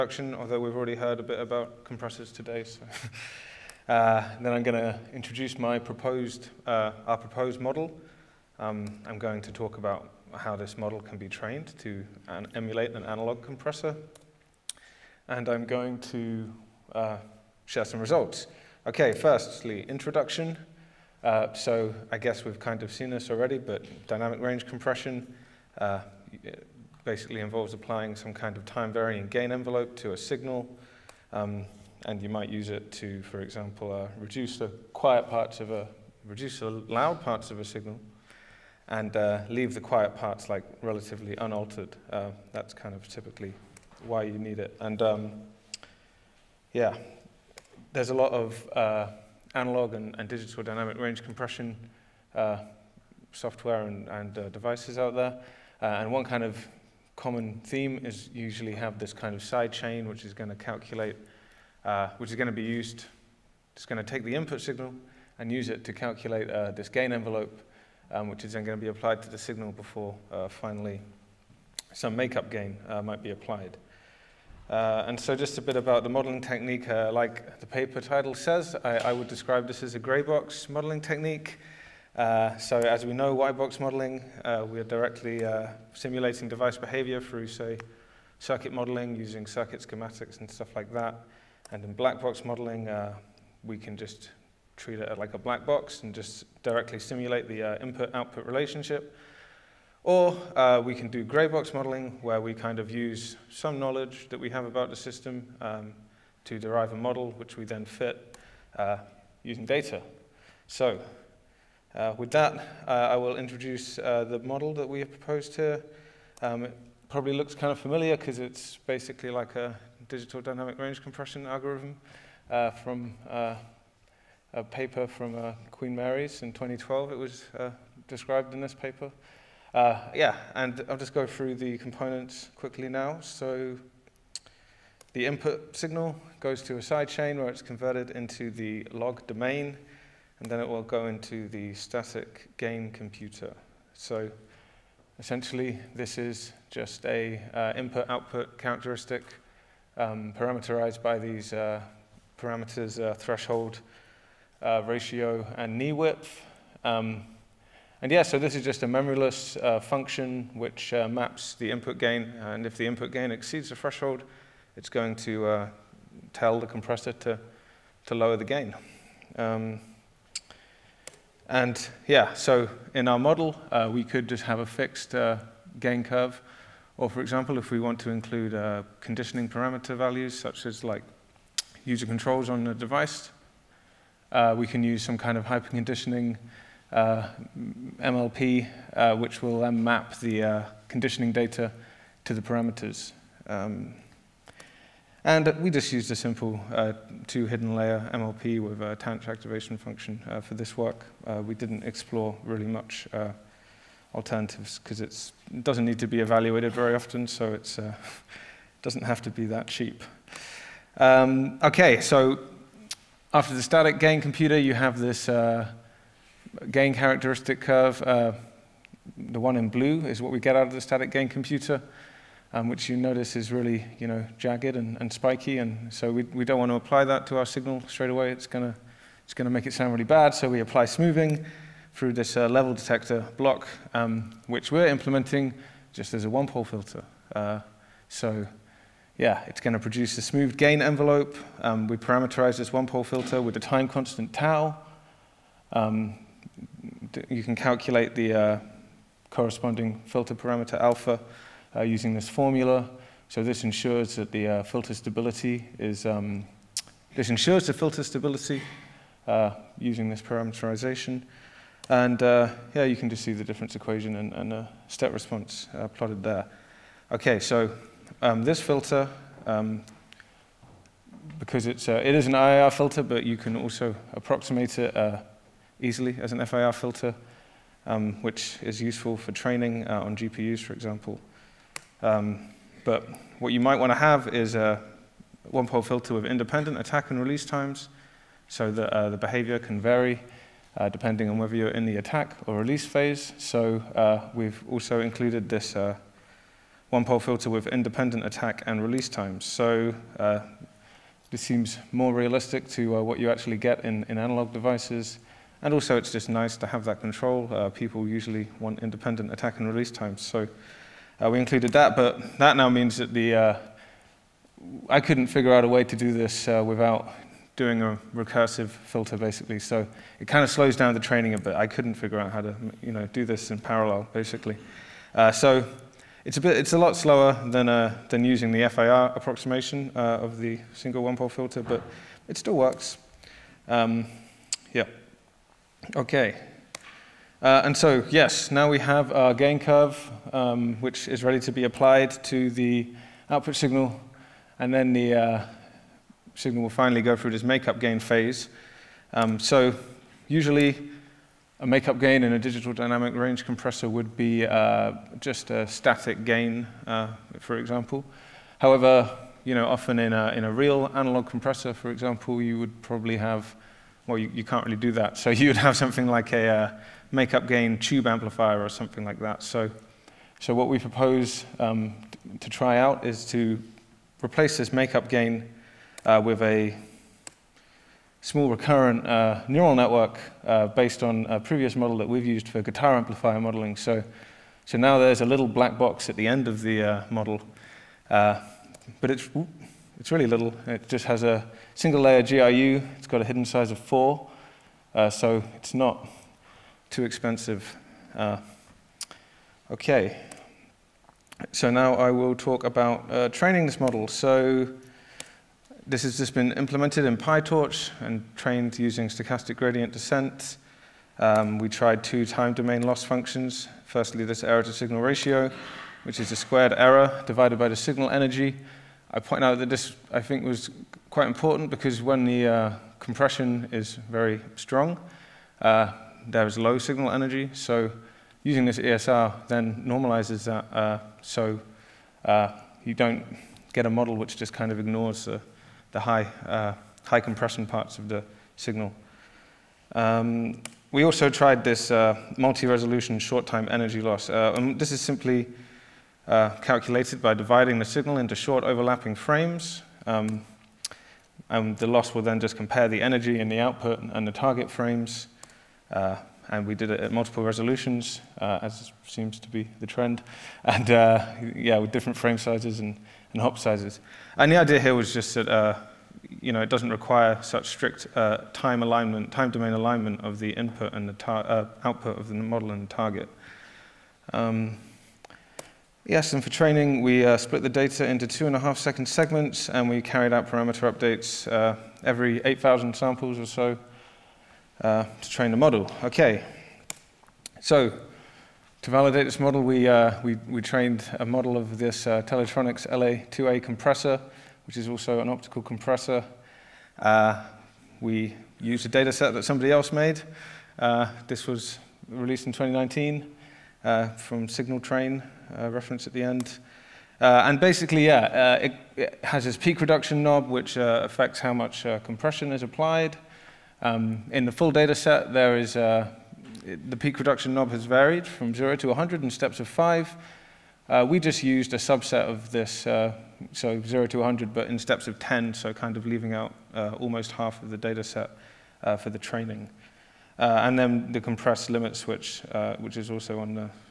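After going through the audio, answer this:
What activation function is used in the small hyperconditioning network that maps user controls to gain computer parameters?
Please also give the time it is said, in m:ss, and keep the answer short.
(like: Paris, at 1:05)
tanh, at 3:18.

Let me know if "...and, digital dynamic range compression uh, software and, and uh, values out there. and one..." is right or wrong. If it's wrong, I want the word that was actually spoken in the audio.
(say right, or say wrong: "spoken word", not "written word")
wrong: "devices", not "values".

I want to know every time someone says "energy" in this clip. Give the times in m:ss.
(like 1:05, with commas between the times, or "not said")
6:58, 7:07, 7:23, 7:33.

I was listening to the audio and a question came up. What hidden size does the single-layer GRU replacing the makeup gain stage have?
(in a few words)
4.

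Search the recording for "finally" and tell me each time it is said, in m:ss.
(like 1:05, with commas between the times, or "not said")
1:10, 5:46.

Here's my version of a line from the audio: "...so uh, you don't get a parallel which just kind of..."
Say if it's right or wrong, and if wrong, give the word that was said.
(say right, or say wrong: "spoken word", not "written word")
wrong: "model", not "parallel".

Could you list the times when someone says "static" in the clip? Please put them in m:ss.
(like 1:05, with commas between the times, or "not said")
2:21, 3:33, 3:40, 5:55.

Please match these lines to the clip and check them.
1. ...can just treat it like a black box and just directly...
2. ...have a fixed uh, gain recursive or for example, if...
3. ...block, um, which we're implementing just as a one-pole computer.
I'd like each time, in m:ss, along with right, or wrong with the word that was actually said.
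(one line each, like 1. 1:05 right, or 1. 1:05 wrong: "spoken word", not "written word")
1. 1:33 right
2. 2:54 wrong: "curve", not "recursive"
3. 3:53 wrong: "filter", not "computer".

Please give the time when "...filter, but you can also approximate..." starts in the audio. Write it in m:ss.
4:32.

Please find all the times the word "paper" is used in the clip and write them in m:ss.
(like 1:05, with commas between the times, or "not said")
1:17, 2:04, 2:08.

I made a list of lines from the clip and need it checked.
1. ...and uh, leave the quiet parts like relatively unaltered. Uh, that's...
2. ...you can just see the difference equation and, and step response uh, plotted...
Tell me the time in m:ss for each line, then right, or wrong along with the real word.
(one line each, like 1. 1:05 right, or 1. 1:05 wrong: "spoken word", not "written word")
1. 0:38 right
2. 4:22 right.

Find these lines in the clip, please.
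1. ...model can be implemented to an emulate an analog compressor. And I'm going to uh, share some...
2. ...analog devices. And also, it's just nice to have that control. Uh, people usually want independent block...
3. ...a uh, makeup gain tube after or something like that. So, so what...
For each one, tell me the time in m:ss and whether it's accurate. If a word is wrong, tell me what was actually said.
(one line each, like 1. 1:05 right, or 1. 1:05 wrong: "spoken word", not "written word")
1. 0:10 wrong: "trained", not "implemented"
2. 5:04 wrong: "attack", not "block"
3. 6:06 wrong: "amplifier", not "after".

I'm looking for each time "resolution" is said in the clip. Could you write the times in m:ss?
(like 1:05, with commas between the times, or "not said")
7:22, 7:37.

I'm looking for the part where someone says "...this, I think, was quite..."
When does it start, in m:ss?
6:59.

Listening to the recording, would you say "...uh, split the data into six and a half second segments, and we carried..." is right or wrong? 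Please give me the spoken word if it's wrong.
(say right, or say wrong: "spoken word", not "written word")
wrong: "two", not "six".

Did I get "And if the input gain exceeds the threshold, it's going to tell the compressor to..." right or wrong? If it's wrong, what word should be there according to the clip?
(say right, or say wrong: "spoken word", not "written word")
right.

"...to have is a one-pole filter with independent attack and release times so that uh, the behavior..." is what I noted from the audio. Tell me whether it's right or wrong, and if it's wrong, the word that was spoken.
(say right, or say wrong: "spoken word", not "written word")
right.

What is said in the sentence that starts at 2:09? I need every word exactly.
Uh, yeah, and I'll just go through the components quickly now.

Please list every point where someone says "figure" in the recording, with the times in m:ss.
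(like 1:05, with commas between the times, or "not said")
5:15, 5:21.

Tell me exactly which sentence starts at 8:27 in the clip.
and basically, yeah, it, it, has this peak reduction knob, which affects how much compression is applied.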